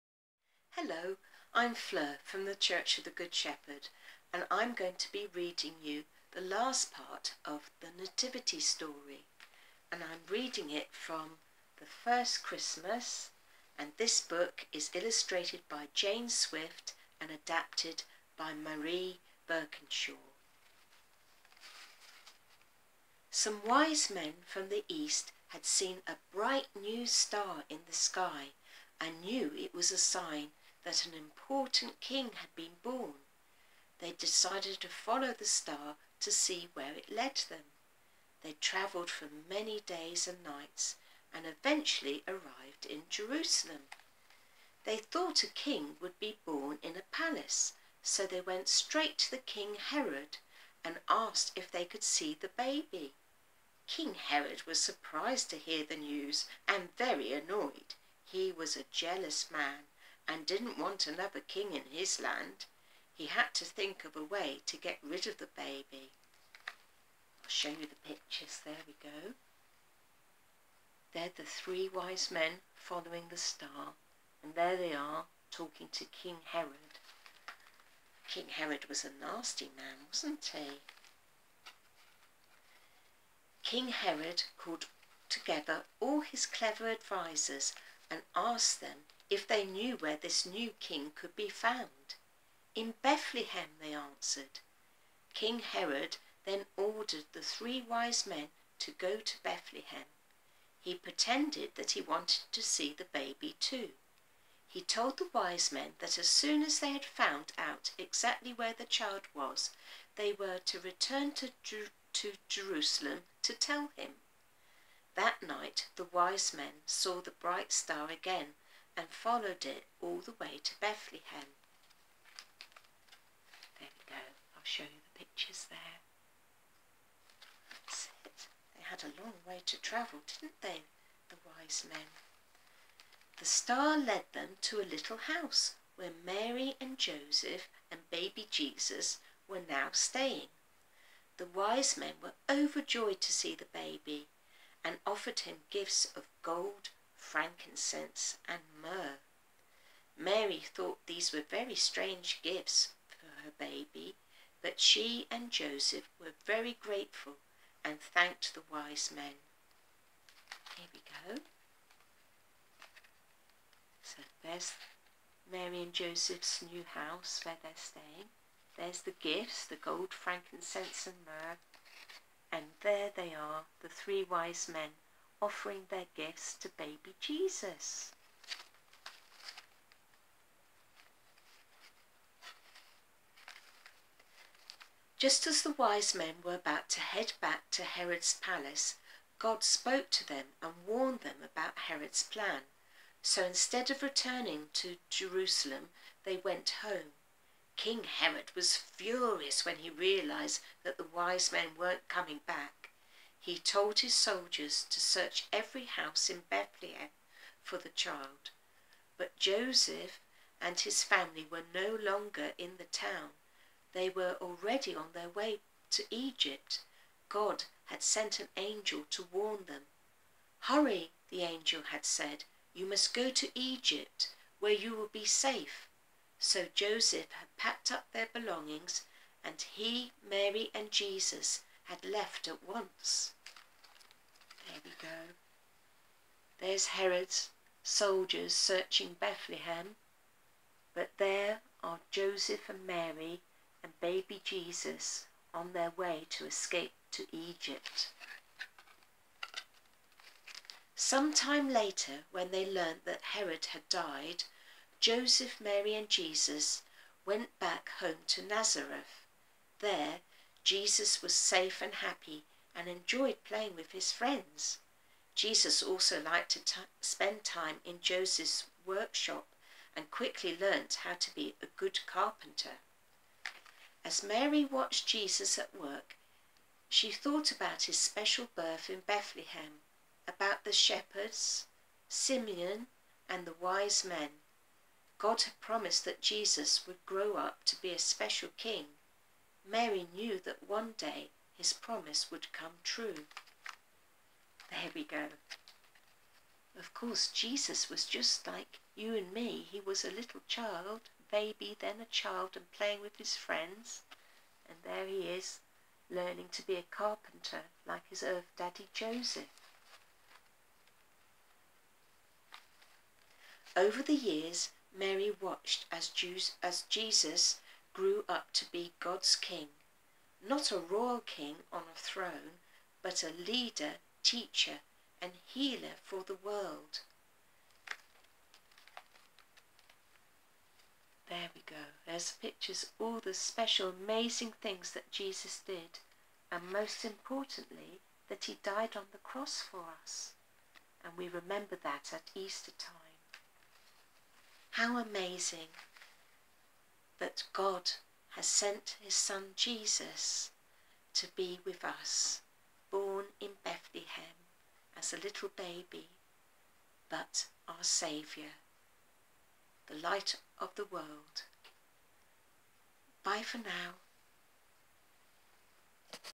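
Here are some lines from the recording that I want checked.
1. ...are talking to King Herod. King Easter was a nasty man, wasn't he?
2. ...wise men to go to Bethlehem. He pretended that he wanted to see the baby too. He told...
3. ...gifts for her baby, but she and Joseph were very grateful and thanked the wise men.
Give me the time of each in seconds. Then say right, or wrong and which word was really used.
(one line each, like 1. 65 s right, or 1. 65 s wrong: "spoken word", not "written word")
1. 74 s wrong: "Herod", not "Easter"
2. 97 s right
3. 152 s right.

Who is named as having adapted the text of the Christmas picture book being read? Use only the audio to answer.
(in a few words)
Marie Birkinshaw.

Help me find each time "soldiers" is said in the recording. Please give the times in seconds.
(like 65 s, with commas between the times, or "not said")
204 s, 237 s.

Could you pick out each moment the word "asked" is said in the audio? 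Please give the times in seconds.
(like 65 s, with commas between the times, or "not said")
51 s, 88 s.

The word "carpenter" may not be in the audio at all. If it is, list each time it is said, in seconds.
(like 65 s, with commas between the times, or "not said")
272 s, 306 s.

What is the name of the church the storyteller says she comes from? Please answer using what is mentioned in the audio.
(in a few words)
Church of the Good Shepherd.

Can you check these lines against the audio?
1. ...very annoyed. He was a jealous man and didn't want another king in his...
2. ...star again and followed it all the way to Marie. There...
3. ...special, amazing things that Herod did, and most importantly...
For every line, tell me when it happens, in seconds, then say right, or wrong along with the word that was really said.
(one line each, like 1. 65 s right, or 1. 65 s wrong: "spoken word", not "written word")
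1. 56 s right
2. 117 s wrong: "Bethlehem", not "Marie"
3. 333 s wrong: "Jesus", not "Herod".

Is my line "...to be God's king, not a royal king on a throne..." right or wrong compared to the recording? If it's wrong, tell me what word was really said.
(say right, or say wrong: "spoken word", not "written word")
right.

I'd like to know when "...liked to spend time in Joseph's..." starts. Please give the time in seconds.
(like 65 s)
266 s.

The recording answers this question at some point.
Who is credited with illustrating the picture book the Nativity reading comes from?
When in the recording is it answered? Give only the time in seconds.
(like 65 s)
15 s.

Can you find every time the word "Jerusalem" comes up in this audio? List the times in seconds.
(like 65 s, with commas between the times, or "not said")
43 s, 112 s, 195 s.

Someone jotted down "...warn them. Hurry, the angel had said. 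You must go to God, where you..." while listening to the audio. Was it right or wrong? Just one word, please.
wrong.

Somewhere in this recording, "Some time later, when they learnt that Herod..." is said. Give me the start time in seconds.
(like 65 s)
250 s.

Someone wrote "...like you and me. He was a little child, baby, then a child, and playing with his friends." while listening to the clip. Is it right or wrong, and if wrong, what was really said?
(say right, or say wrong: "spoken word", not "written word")
right.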